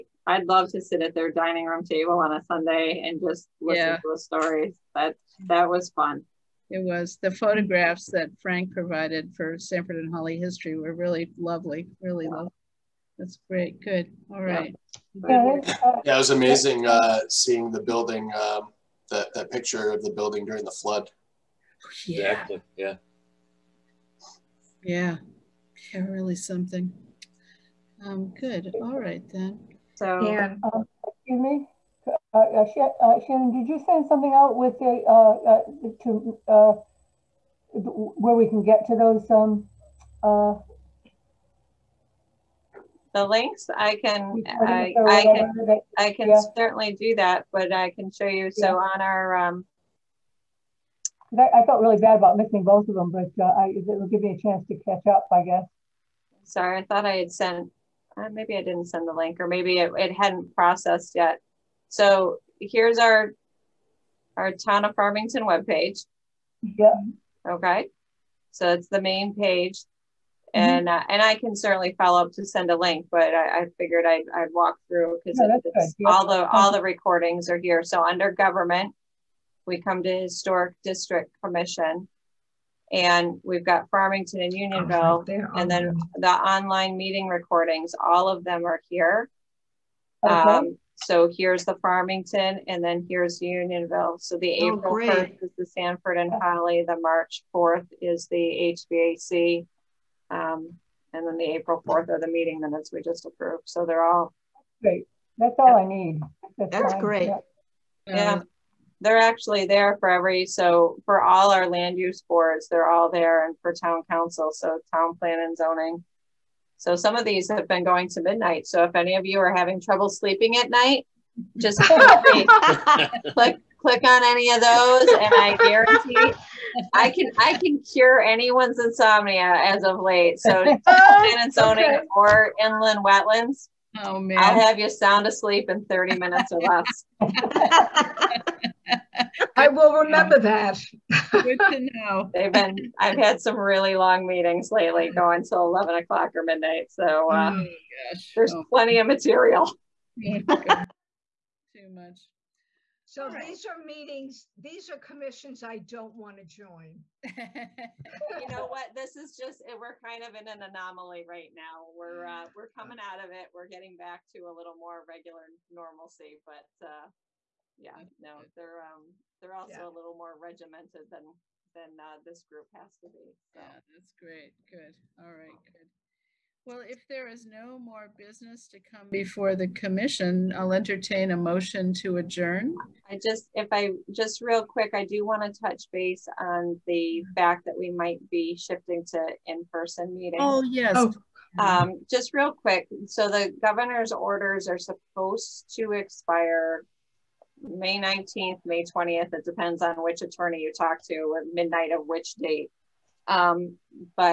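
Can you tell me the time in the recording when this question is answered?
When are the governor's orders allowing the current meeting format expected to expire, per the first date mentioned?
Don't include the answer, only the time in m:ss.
3:17.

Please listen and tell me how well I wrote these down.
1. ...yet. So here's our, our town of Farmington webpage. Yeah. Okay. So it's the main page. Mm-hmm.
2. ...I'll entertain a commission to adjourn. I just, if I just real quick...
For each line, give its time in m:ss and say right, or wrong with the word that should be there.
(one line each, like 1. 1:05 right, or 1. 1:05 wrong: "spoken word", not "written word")
1. 1:01 right
2. 3:00 wrong: "motion", not "commission".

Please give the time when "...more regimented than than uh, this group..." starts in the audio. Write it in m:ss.
2:50.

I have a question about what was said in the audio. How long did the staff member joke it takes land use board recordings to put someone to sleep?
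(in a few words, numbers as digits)
30 minutes.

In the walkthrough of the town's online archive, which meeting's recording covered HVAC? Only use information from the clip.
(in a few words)
March 4th.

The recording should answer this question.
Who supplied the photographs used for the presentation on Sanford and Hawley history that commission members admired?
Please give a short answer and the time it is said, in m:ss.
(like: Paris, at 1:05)
Frank, at 0:08.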